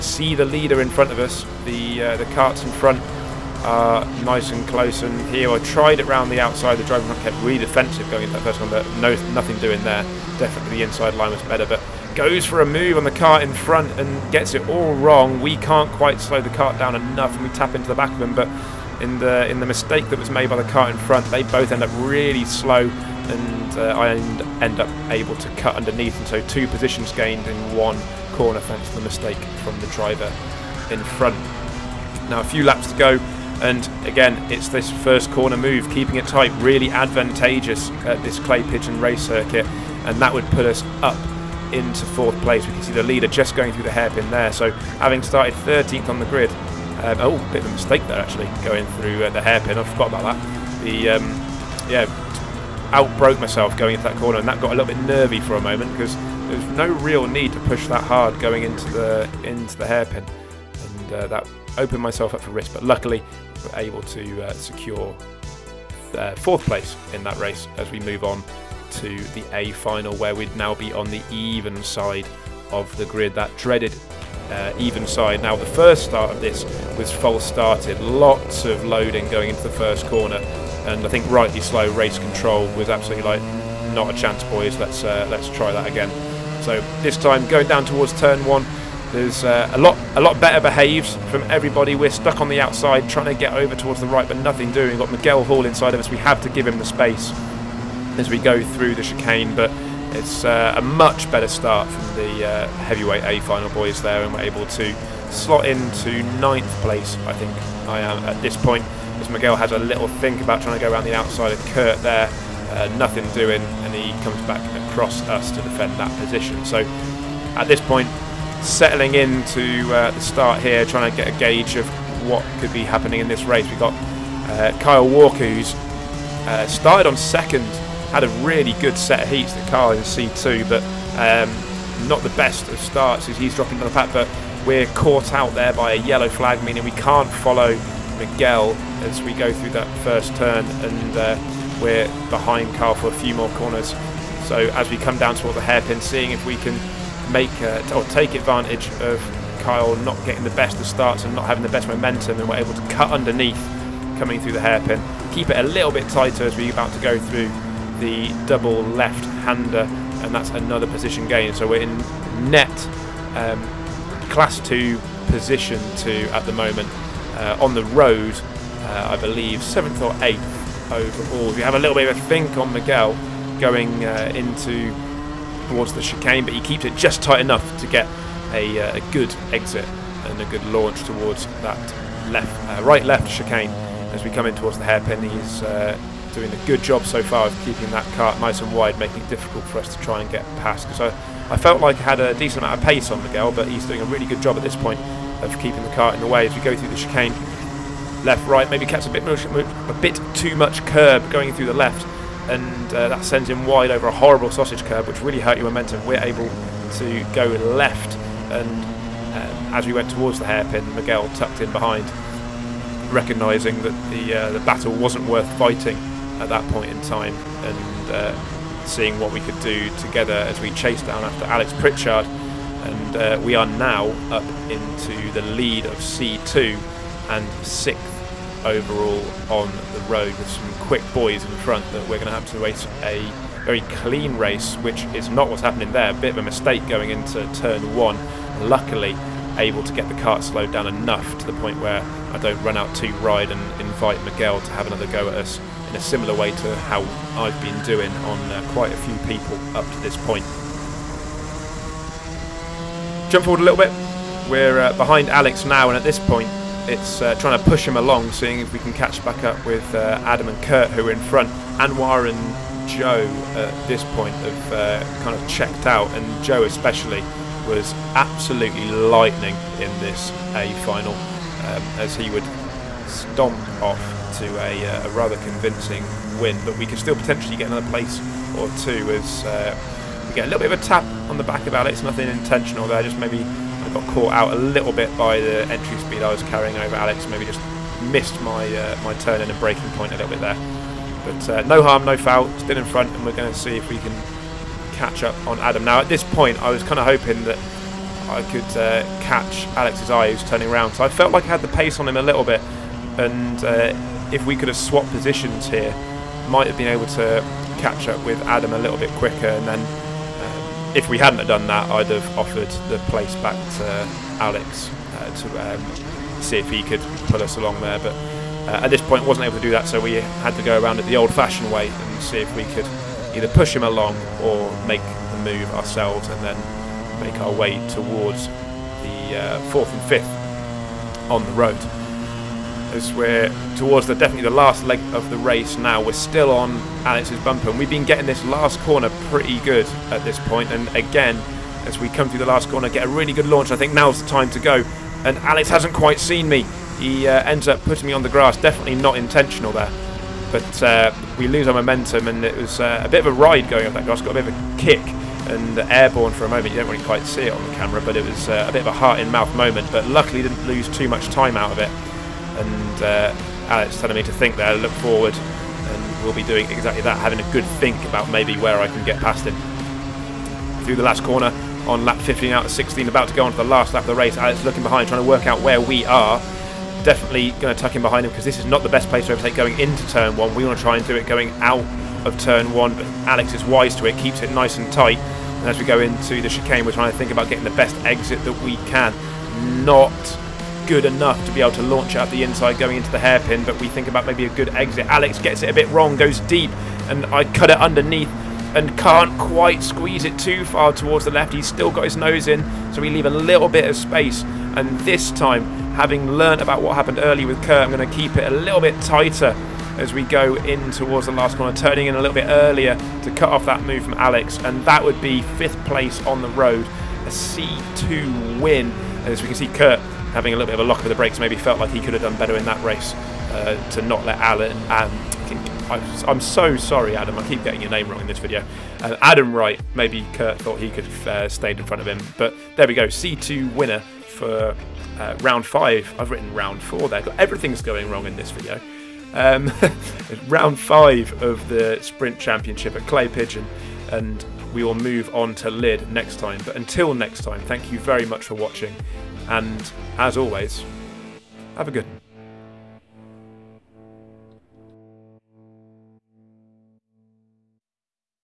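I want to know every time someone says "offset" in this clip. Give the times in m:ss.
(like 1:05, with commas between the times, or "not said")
not said.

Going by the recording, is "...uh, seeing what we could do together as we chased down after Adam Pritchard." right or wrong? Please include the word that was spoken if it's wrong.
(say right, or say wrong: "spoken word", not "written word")
wrong: "Alex", not "Adam".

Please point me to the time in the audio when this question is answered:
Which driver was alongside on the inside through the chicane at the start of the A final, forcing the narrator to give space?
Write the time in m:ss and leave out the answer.
1:35.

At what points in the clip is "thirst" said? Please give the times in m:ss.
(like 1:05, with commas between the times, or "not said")
not said.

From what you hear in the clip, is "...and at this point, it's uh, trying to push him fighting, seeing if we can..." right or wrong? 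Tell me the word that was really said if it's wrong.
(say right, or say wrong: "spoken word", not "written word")
wrong: "along", not "fighting".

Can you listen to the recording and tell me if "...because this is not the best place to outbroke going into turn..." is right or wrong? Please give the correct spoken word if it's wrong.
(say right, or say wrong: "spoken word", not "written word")
wrong: "overtake", not "outbroke".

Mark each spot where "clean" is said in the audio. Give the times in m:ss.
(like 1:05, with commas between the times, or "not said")
3:53.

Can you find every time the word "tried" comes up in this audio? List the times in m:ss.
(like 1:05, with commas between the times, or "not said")
0:05.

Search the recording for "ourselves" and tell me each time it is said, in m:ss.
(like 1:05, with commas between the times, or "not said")
5:25.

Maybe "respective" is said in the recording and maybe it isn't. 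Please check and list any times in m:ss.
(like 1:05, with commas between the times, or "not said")
not said.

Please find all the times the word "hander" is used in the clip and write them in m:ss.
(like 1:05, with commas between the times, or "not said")
2:38.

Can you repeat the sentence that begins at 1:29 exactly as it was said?
There's uh, a lot, a lot better behaves from everybody.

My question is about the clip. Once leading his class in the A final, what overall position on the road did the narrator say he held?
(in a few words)
sixth.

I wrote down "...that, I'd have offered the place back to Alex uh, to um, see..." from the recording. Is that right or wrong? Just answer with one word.
right.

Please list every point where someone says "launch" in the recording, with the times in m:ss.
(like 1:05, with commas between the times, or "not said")
3:00, 5:43, 6:31.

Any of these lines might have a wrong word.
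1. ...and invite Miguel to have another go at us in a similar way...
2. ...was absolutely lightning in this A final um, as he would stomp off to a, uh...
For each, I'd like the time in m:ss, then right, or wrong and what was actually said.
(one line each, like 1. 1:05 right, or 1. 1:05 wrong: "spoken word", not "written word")
1. 4:03 right
2. 4:27 right.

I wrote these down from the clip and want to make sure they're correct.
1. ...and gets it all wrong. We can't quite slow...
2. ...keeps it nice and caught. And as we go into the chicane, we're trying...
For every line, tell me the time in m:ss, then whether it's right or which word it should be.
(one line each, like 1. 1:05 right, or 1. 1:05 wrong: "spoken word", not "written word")
1. 0:13 right
2. 6:24 wrong: "tight", not "caught".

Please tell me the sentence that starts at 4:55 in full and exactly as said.
Now at this point, I was kind of hoping that I could uh, catch Alex's eye, who's turning around.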